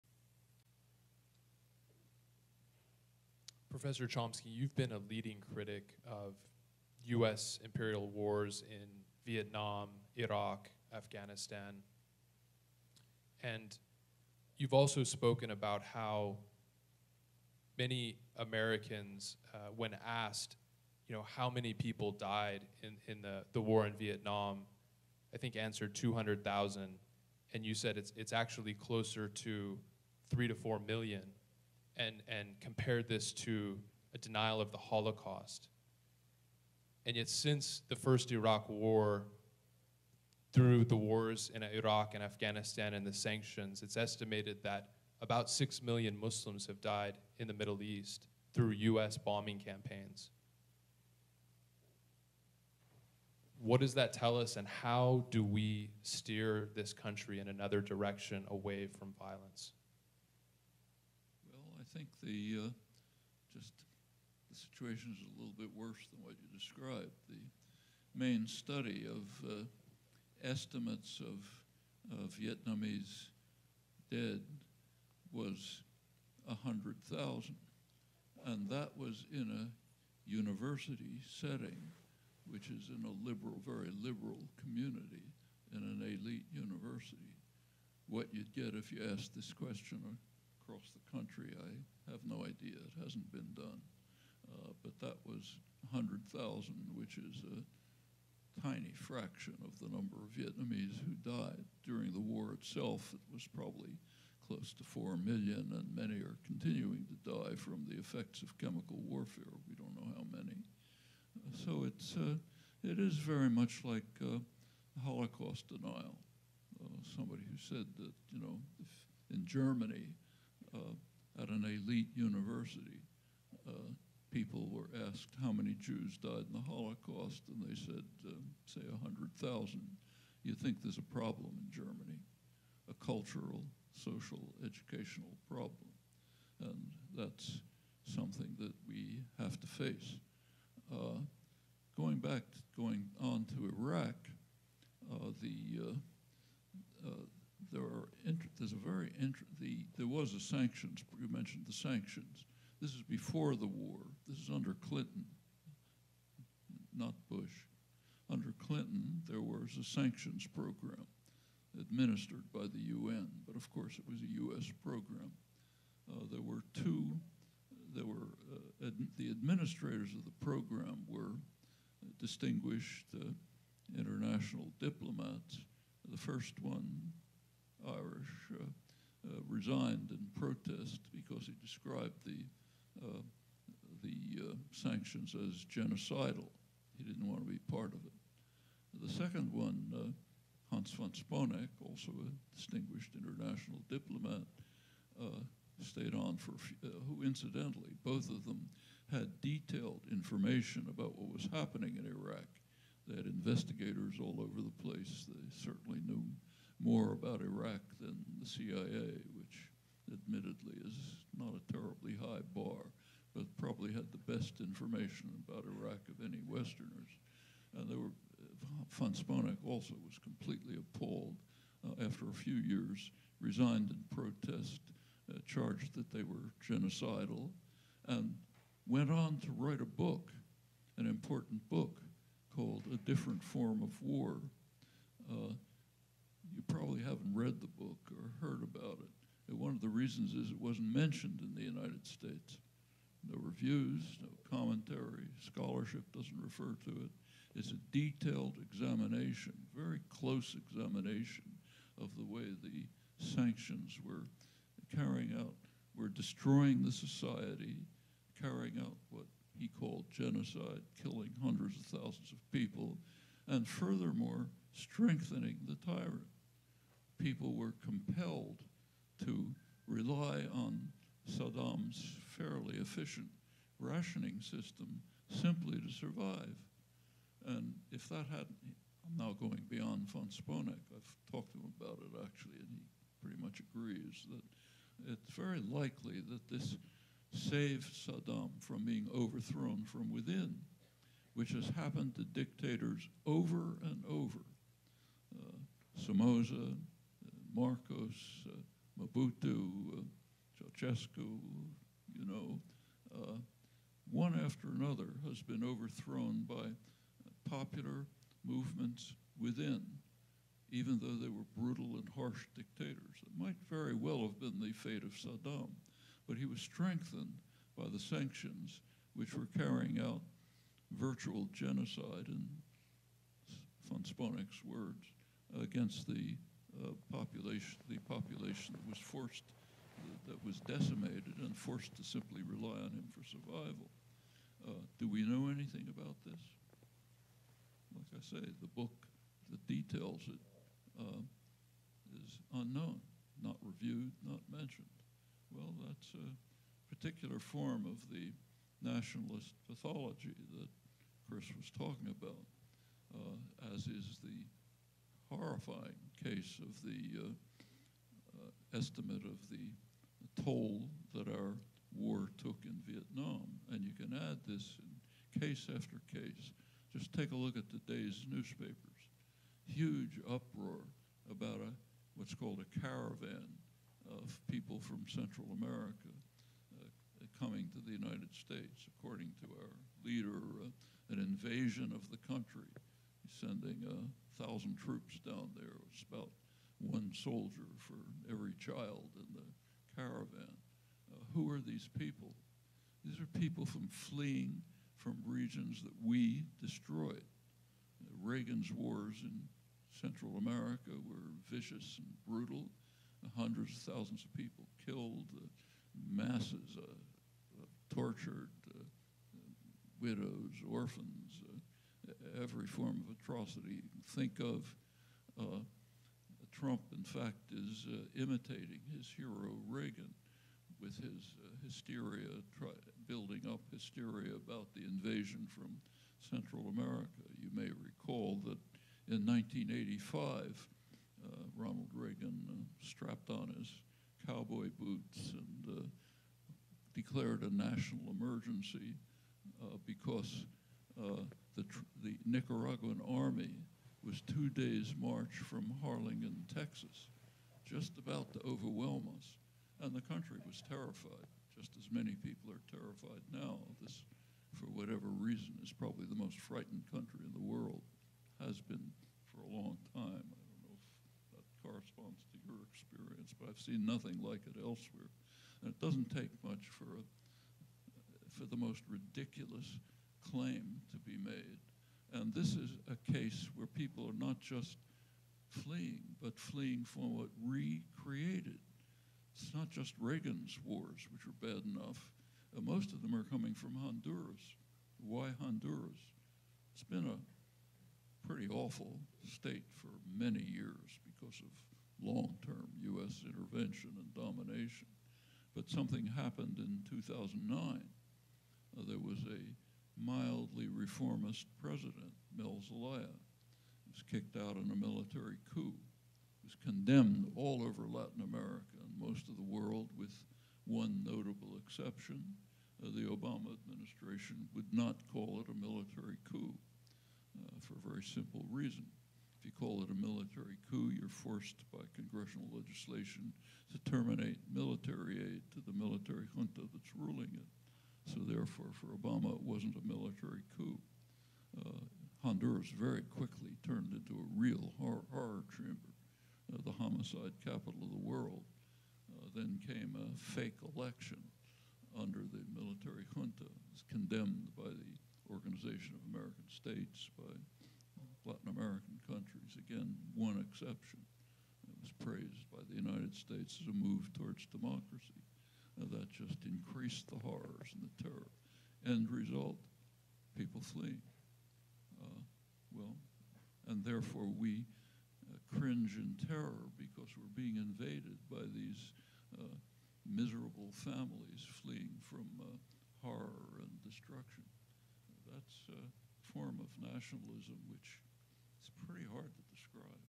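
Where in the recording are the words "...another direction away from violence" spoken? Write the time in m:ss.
0:57.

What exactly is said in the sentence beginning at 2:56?
The first one Irish, uh, uh, resigned in protest because he described the, uh, the sanctions as genocidal.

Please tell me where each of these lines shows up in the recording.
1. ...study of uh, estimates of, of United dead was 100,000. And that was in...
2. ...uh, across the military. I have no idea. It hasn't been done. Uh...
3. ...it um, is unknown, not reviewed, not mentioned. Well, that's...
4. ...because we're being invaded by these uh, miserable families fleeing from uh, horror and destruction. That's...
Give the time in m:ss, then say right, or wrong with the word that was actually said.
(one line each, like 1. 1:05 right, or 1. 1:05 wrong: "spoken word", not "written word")
1. 1:08 wrong: "Vietnamese", not "United"
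2. 1:30 wrong: "country", not "military"
3. 5:40 right
4. 9:26 right.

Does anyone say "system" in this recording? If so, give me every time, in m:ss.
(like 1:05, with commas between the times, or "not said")
4:34.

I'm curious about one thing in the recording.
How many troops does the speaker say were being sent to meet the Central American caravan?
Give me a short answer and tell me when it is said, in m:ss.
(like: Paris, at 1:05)
1,000, at 6:23.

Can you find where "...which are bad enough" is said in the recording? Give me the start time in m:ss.
8:01.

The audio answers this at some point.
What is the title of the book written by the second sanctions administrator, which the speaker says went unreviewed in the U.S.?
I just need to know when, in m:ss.
3:52.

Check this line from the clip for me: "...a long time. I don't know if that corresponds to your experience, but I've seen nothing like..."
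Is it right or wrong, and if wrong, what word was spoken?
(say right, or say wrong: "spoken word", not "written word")
right.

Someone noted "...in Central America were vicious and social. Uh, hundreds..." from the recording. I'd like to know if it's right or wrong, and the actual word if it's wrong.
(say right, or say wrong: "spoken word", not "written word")
wrong: "brutal", not "social".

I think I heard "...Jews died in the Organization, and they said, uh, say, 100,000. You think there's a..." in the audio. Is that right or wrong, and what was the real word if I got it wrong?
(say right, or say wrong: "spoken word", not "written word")
wrong: "Holocaust", not "Organization".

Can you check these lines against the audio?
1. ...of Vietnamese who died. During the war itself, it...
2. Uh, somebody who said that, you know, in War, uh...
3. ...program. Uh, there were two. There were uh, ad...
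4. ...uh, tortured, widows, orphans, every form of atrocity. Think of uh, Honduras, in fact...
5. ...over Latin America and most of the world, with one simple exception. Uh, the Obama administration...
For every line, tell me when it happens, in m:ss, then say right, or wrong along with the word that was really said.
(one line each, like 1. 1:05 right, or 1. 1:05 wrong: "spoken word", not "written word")
1. 1:40 right
2. 1:56 wrong: "Germany", not "War"
3. 2:44 right
4. 6:46 wrong: "Trump", not "Honduras"
5. 8:27 wrong: "notable", not "simple".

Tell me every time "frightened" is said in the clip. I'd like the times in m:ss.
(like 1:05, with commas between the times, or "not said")
7:36.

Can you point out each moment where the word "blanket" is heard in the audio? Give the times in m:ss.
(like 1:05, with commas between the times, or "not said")
not said.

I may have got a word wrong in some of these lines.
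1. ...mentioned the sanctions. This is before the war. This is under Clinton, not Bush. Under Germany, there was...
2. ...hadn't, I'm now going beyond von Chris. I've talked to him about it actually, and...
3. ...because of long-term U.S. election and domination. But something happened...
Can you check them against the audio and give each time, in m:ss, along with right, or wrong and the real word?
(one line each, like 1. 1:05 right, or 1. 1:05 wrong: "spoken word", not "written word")
1. 2:31 wrong: "Clinton", not "Germany"
2. 4:38 wrong: "Sponeck", not "Chris"
3. 8:11 wrong: "intervention", not "election".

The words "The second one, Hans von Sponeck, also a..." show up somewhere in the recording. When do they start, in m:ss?
3:09.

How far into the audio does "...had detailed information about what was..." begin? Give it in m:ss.
3:19.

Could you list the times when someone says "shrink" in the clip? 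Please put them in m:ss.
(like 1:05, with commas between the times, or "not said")
not said.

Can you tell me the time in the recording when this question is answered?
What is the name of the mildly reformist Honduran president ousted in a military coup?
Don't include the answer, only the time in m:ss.
8:22.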